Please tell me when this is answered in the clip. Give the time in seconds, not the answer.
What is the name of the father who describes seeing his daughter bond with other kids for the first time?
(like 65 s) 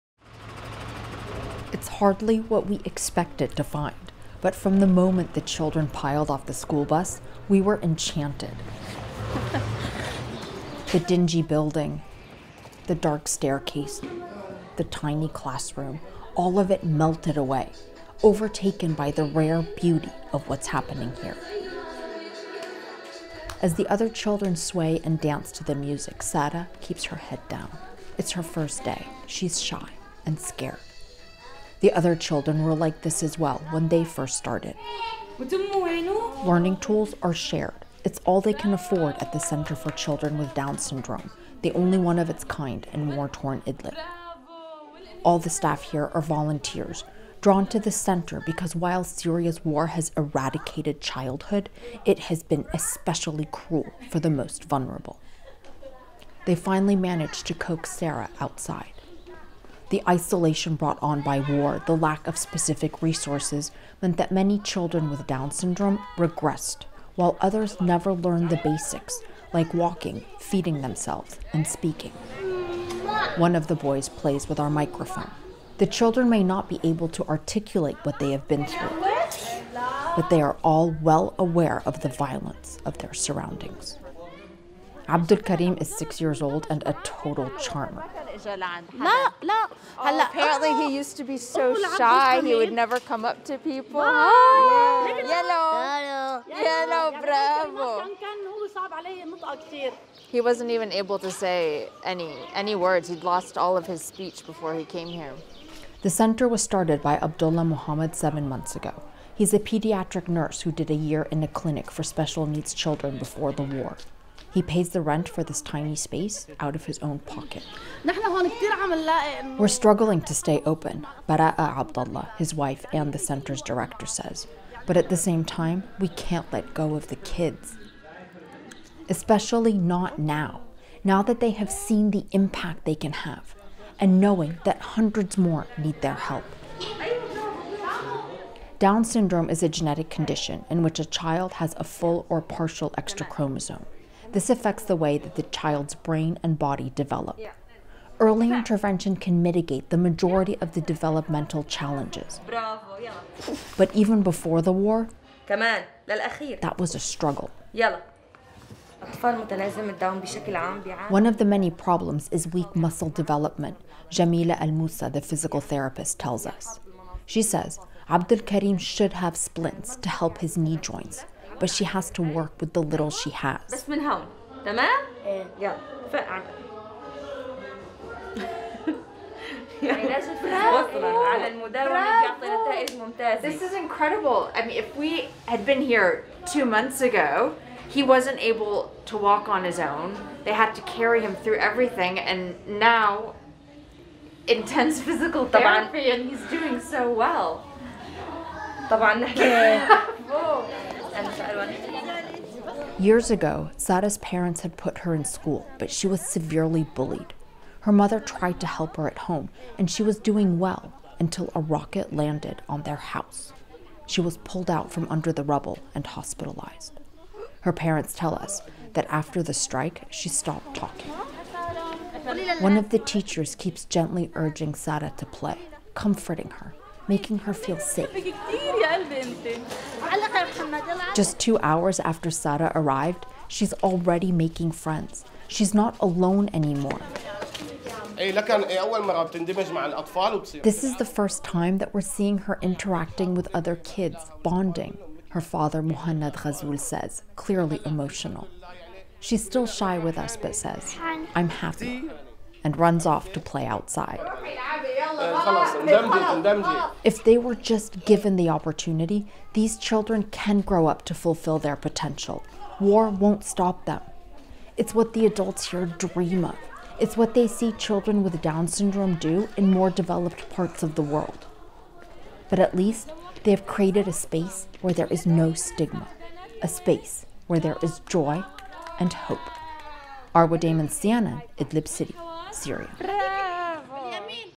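245 s.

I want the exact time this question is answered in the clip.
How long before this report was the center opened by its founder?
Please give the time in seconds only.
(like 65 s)
108 s.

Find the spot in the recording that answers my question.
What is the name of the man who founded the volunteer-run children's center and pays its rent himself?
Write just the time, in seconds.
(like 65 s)
107 s.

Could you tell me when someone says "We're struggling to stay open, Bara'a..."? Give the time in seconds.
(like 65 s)
119 s.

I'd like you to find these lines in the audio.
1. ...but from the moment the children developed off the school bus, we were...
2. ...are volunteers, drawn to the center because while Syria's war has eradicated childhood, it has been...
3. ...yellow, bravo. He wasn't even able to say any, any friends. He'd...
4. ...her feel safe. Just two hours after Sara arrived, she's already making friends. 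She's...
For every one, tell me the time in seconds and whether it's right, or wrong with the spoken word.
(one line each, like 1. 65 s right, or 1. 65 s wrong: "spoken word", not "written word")
1. 4 s wrong: "piled", not "developed"
2. 46 s right
3. 96 s wrong: "words", not "friends"
4. 227 s right.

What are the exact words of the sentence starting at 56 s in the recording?
They finally managed to coax Sarah outside.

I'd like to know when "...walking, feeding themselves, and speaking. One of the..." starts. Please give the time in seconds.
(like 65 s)
69 s.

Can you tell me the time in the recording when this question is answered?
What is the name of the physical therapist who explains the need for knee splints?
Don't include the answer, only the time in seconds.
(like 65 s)
164 s.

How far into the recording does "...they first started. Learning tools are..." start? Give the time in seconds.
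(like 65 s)
33 s.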